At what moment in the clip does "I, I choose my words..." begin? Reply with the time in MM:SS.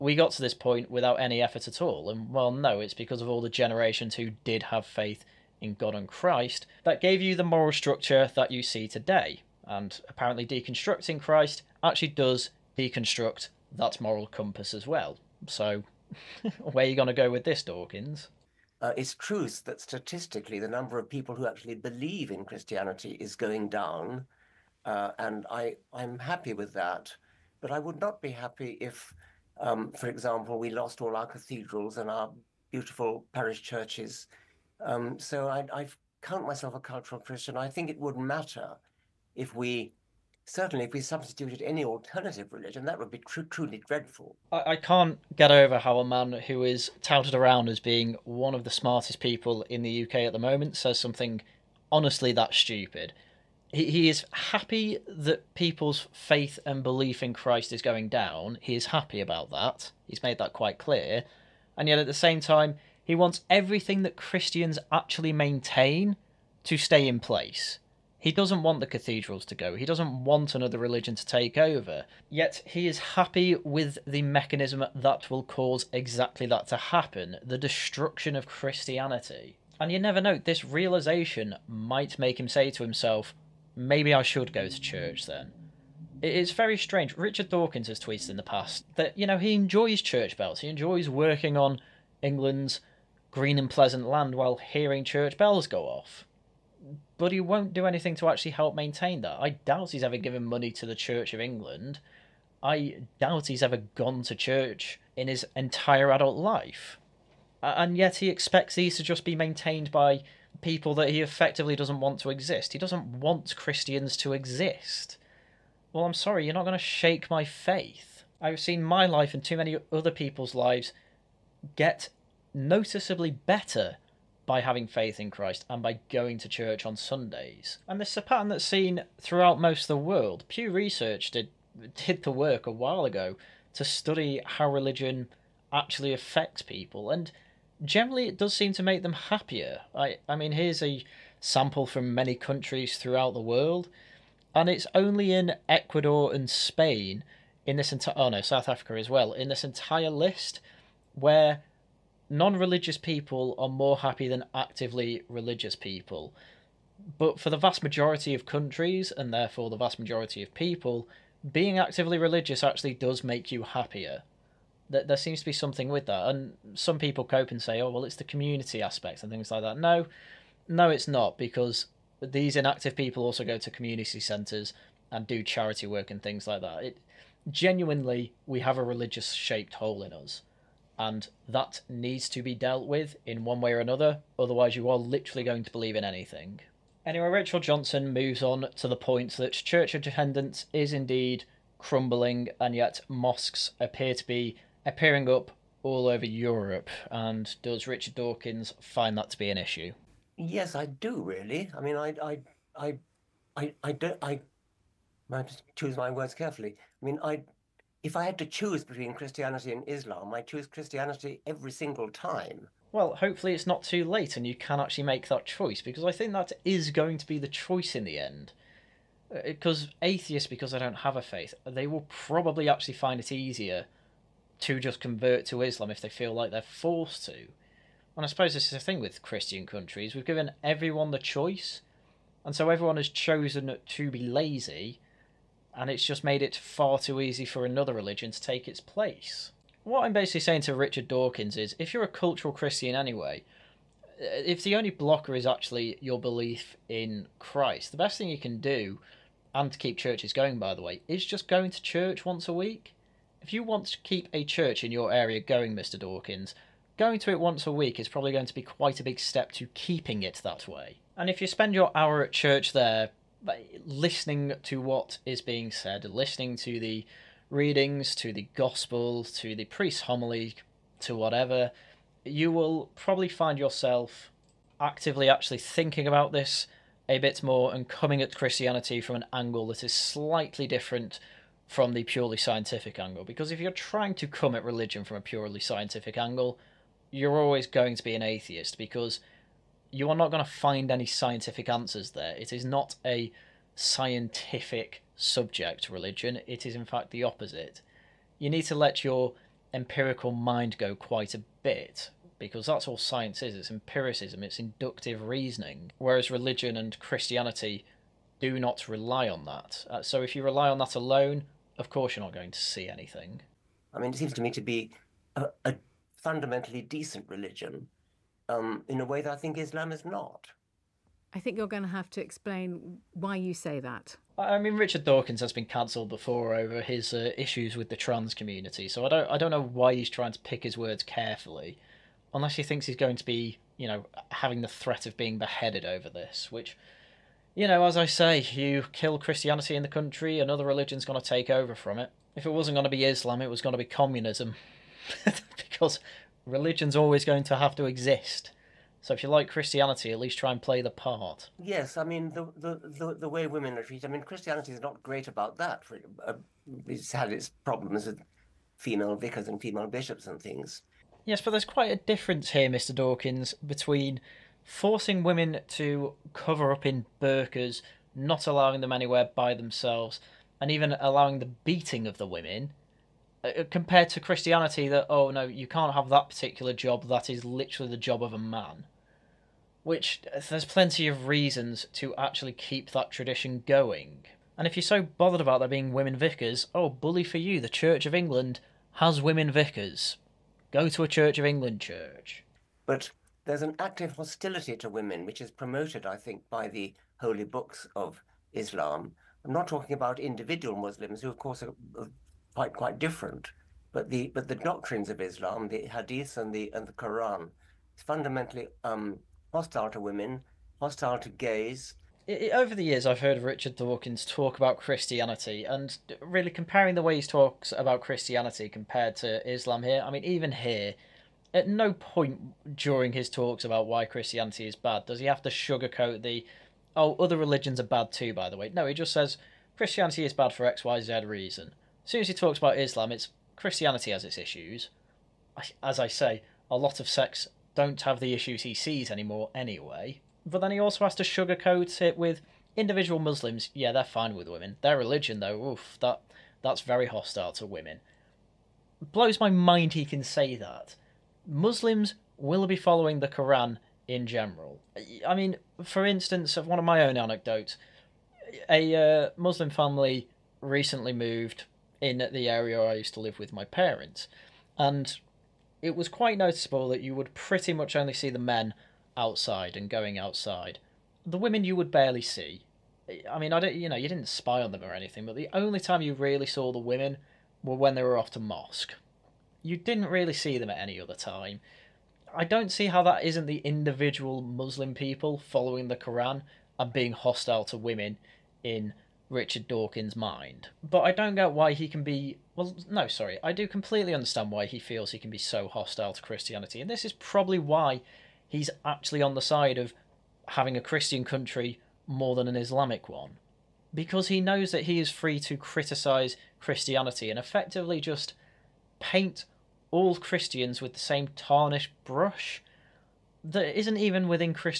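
03:24.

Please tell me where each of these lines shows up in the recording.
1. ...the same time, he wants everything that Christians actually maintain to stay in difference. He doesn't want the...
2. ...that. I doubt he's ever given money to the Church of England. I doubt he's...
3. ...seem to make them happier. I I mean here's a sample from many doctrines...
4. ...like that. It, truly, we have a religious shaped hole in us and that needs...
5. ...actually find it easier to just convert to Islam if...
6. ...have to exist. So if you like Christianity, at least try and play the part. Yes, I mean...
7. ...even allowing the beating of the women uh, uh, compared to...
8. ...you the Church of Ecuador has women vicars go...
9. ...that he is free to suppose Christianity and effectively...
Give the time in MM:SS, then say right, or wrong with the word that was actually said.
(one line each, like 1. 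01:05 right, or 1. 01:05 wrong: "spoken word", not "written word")
1. 01:02 wrong: "place", not "difference"
2. 01:39 right
3. 02:18 wrong: "countries", not "doctrines"
4. 02:56 wrong: "genuinely", not "truly"
5. 03:42 right
6. 05:47 right
7. 06:10 right
8. 06:27 wrong: "England", not "Ecuador"
9. 08:24 wrong: "criticise", not "suppose".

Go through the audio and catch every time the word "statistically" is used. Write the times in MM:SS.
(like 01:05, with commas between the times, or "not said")
00:19.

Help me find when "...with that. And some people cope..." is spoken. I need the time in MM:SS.
02:45.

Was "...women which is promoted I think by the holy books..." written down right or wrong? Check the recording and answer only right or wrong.
right.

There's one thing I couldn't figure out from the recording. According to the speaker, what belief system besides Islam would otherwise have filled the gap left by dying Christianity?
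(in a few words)
communism.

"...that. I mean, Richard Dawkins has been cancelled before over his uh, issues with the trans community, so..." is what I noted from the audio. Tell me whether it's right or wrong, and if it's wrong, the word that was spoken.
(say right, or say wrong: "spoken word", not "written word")
right.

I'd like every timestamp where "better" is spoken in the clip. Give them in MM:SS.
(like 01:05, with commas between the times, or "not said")
02:03.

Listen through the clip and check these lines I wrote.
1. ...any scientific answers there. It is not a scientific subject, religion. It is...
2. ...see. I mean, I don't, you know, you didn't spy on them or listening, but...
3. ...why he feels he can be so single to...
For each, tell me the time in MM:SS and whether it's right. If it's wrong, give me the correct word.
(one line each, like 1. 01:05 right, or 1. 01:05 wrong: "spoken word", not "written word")
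1. 04:50 right
2. 07:52 wrong: "anything", not "listening"
3. 08:14 wrong: "hostile", not "single".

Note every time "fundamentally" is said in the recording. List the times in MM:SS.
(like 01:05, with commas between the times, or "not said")
05:16, 06:48.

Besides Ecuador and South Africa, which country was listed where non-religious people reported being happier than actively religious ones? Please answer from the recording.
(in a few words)
Spain.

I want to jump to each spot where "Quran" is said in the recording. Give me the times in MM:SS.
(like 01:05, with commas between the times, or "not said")
06:46, 07:33, 08:05.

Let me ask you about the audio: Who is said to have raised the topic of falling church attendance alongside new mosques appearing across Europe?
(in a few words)
Rachel Johnson.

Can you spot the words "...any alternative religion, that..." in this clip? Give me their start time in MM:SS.
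00:41.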